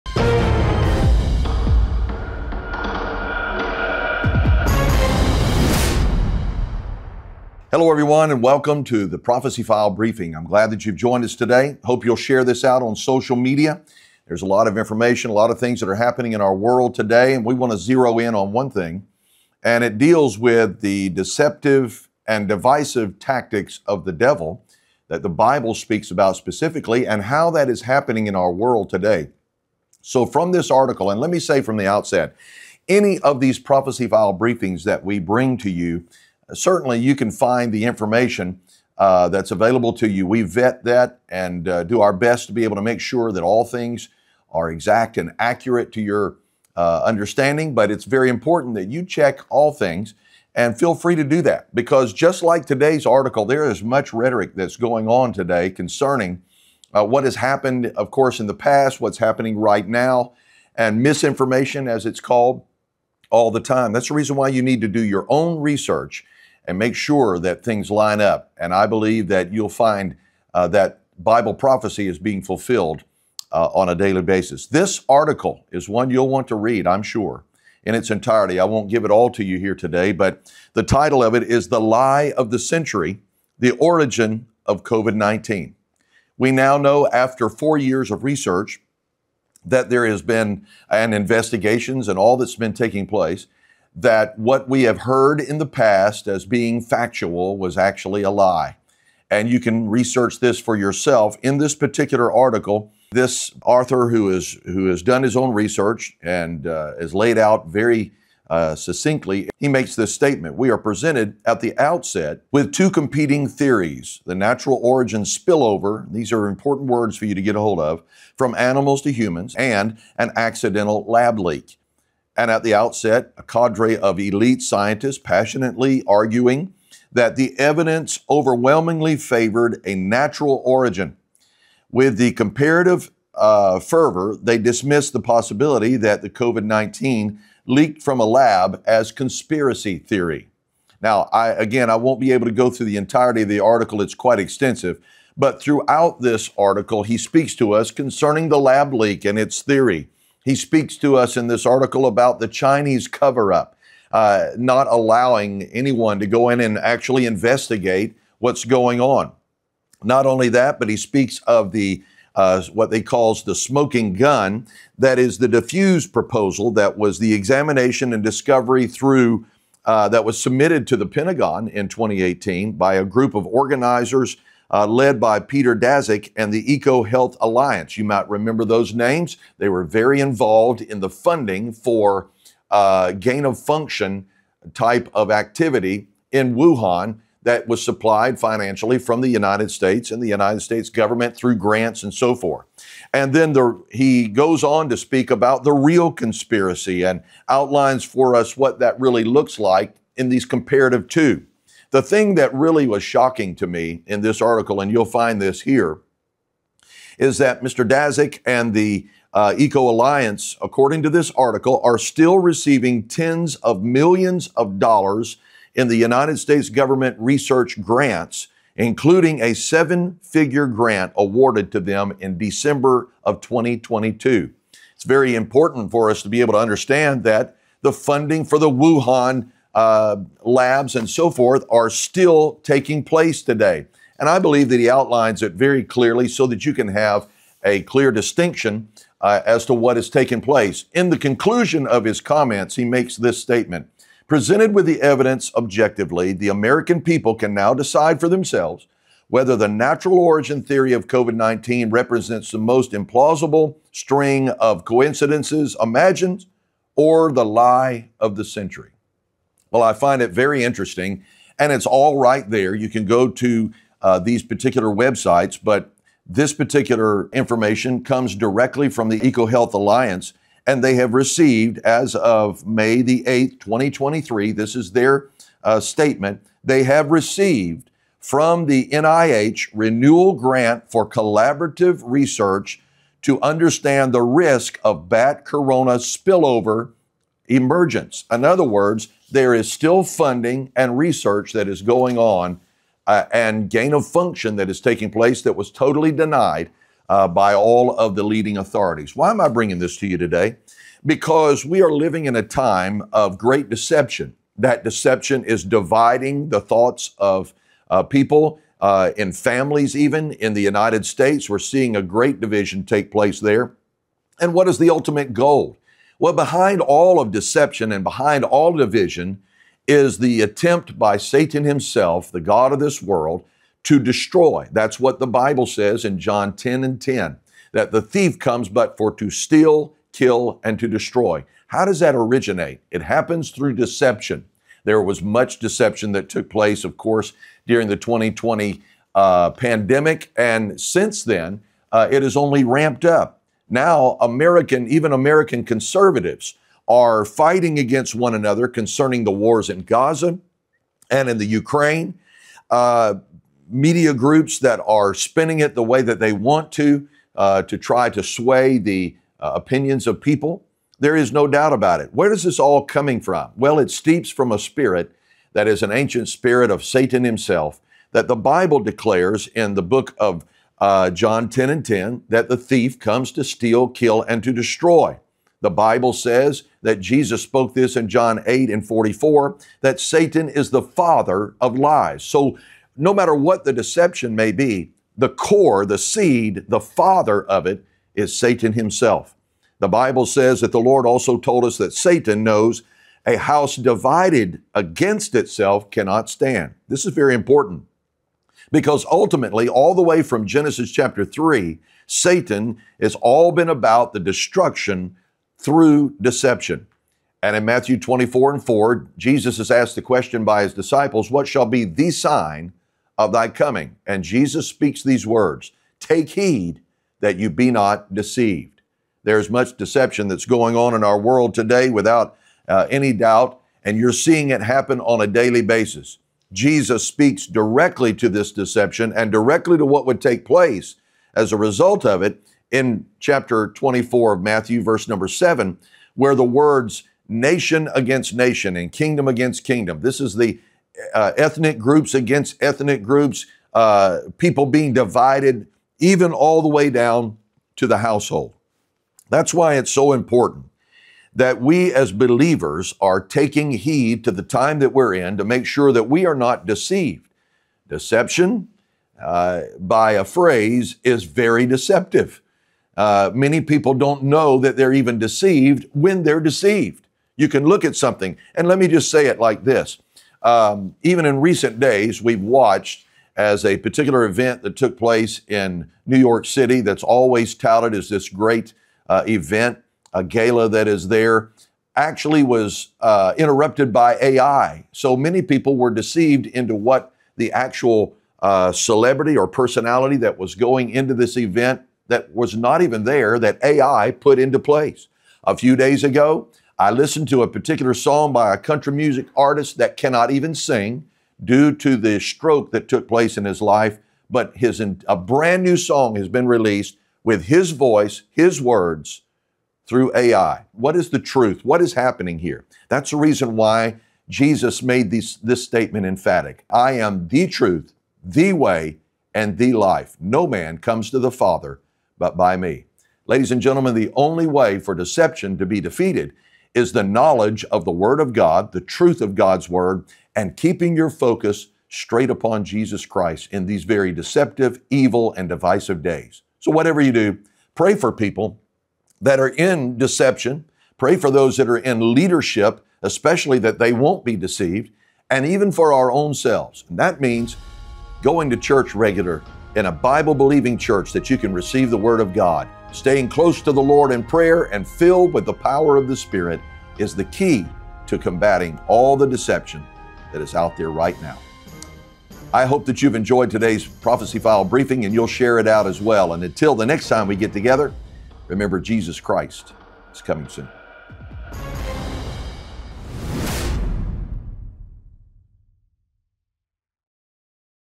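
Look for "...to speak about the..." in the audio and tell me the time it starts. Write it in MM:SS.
03:14.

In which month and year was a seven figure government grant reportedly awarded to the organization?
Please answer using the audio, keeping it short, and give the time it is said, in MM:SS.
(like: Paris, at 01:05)
December 2022, at 03:42.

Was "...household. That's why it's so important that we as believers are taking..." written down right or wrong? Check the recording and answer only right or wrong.
right.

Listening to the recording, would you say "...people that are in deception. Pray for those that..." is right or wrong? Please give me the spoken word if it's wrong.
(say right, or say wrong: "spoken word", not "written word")
right.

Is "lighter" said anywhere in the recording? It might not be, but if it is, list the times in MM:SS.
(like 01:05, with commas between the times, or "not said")
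not said.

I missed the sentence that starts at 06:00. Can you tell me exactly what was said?
There is no doubt about it.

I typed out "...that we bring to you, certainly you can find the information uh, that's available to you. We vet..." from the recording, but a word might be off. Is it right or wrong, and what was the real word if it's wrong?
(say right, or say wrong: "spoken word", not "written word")
right.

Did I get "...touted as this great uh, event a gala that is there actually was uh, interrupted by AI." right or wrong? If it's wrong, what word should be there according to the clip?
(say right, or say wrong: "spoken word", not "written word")
right.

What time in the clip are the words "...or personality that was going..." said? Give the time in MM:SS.
08:09.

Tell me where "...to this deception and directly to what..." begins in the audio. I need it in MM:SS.
07:08.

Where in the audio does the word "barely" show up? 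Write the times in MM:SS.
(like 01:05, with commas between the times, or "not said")
not said.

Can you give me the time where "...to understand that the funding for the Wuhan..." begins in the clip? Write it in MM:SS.
03:46.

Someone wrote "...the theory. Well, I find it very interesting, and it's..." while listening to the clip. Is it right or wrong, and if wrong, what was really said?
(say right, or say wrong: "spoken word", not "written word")
wrong: "century", not "theory".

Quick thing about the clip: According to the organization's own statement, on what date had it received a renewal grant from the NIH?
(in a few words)
May 8, 2023.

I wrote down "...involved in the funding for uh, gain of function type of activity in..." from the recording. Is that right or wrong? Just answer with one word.
right.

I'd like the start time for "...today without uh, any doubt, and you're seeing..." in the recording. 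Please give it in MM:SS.
07:01.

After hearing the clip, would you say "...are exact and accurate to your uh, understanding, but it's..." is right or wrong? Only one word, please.
right.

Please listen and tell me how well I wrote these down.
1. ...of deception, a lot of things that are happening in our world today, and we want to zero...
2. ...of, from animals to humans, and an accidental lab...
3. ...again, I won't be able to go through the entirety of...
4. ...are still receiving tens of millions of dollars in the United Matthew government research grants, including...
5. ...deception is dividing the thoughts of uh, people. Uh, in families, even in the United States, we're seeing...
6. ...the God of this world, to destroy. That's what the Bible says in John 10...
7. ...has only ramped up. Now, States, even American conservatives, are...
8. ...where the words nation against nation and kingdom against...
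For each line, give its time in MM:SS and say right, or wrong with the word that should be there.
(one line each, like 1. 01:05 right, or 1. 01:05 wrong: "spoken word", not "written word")
1. 00:14 wrong: "information", not "deception"
2. 01:57 right
3. 02:21 right
4. 03:31 wrong: "States", not "Matthew"
5. 05:04 right
6. 05:22 right
7. 05:42 wrong: "American", not "States"
8. 07:16 right.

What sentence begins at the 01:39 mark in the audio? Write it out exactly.
And you can research this for yourself.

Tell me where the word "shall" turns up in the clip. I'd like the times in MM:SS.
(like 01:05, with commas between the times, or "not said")
06:51.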